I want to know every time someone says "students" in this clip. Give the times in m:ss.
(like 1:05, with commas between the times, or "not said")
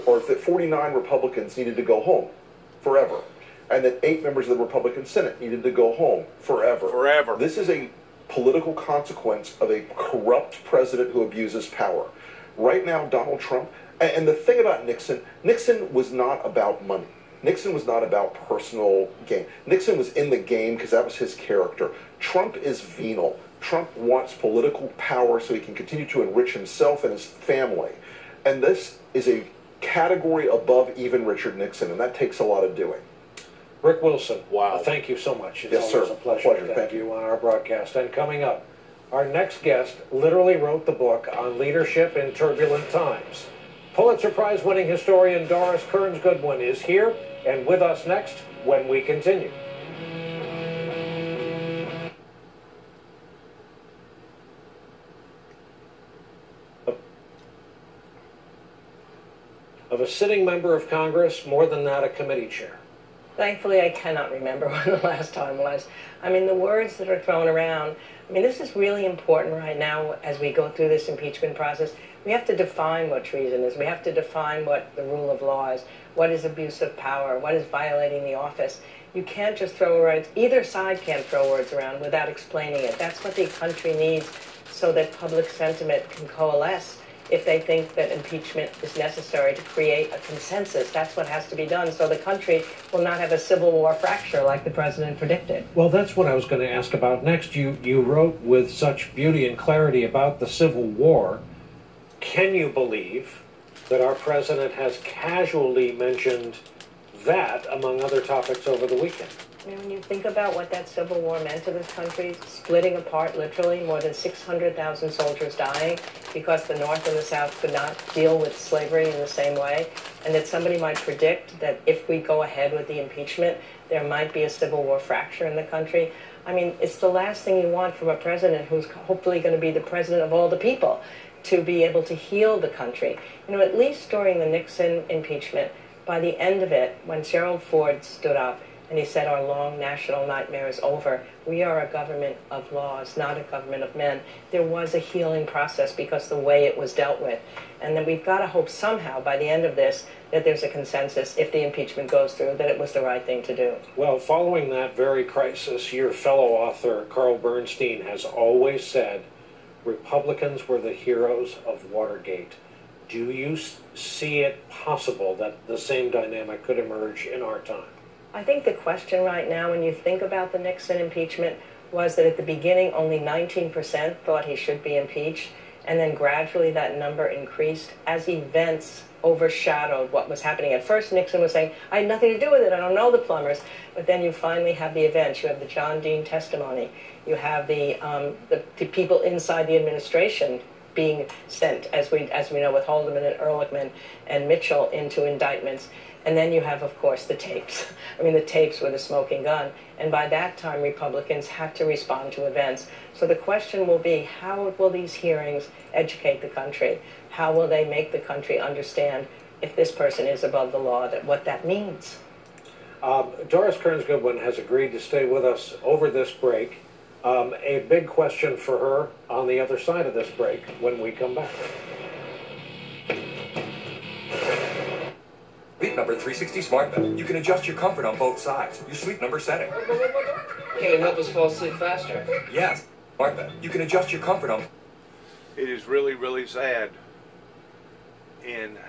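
not said.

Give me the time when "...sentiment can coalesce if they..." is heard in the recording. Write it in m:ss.
1:25.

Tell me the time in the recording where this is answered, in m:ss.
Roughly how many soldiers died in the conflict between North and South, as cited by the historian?
1:53.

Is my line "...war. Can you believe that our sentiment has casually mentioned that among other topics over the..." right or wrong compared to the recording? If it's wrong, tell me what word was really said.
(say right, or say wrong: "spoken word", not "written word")
wrong: "president", not "sentiment".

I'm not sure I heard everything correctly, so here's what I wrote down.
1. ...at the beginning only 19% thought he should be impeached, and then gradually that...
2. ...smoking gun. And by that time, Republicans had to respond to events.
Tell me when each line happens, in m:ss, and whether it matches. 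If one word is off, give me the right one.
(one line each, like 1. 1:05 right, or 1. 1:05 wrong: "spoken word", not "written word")
1. 2:52 right
2. 3:18 right.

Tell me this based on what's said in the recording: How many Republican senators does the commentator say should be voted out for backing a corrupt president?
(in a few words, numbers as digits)
8.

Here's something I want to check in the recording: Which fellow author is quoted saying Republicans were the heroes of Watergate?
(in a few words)
Carl Bernstein.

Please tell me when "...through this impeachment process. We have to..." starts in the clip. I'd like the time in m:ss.
1:10.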